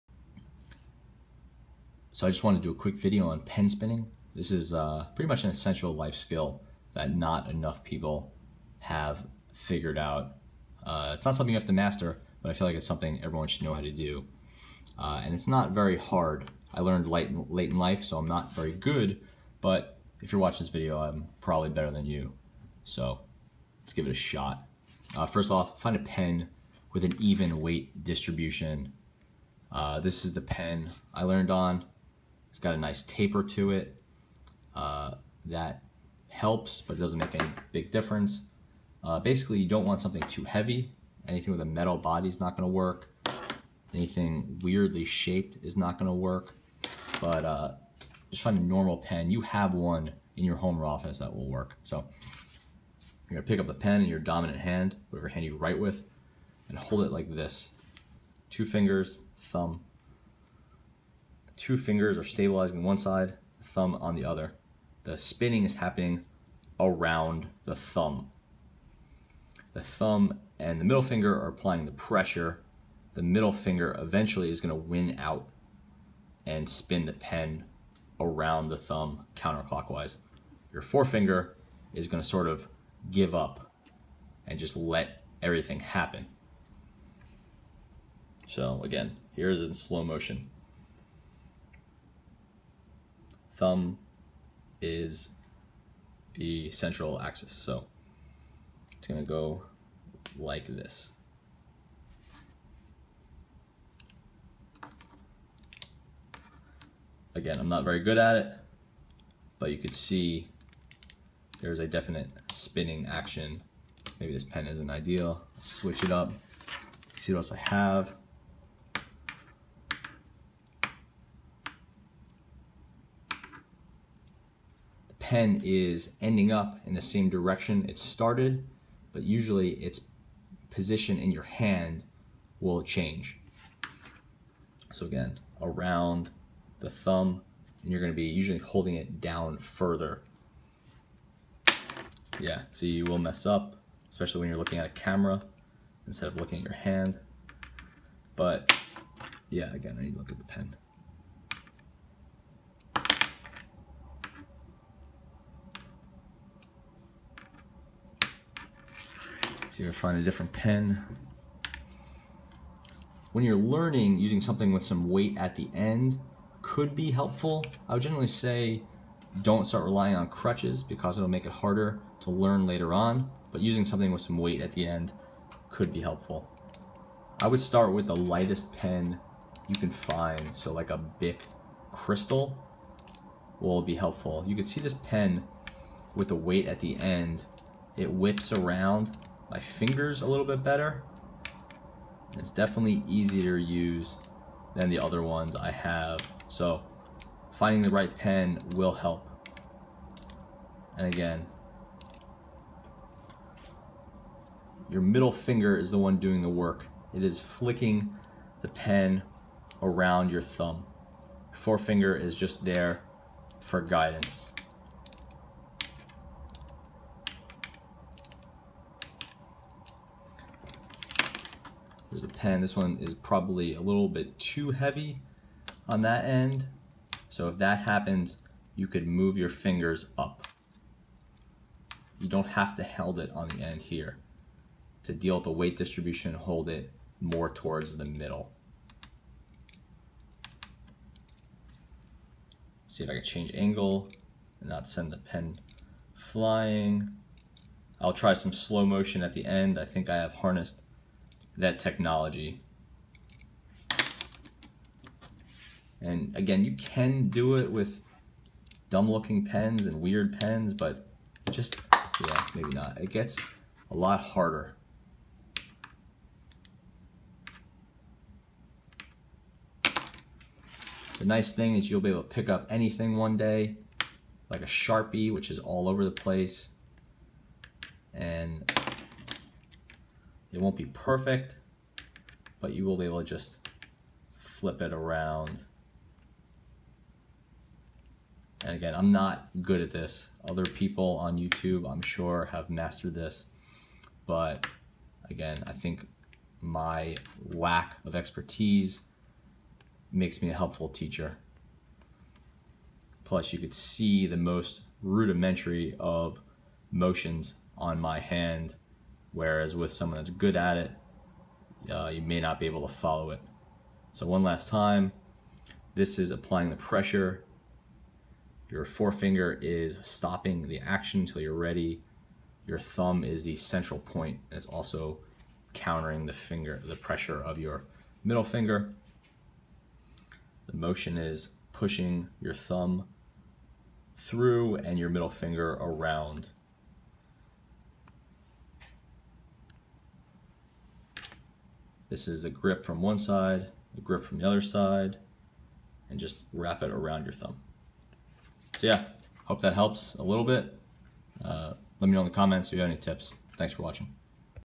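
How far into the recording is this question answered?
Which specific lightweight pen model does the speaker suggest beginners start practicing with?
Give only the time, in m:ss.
3:00.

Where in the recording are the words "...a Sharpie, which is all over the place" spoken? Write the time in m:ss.
4:34.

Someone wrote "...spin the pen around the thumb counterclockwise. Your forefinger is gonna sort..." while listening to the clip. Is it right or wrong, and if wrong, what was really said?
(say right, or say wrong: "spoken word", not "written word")
right.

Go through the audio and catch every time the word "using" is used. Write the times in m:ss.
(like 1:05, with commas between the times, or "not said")
2:44, 2:53.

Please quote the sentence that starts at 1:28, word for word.
So again, here's in slow motion thumb is the central axis.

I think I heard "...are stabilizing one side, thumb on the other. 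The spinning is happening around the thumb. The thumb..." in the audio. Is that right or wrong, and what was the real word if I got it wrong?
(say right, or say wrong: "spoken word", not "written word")
right.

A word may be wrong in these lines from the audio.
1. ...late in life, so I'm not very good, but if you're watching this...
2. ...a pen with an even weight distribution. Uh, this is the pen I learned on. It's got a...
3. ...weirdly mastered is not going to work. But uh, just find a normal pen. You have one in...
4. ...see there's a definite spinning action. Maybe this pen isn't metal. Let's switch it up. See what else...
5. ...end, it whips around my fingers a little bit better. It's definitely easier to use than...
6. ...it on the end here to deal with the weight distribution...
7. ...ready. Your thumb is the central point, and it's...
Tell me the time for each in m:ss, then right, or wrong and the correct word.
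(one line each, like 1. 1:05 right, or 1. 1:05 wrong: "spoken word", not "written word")
1. 0:17 right
2. 0:25 right
3. 0:44 wrong: "shaped", not "mastered"
4. 1:49 wrong: "ideal", not "metal"
5. 3:07 right
6. 3:53 right
7. 5:21 right.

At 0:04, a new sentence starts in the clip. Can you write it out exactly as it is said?
This is uh, pretty much an essential life skill that not enough people have figured out.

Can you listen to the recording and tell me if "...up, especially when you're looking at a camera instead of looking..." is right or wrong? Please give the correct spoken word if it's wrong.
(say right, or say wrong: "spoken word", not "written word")
right.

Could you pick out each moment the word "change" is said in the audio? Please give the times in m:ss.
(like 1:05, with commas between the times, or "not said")
2:12, 4:03.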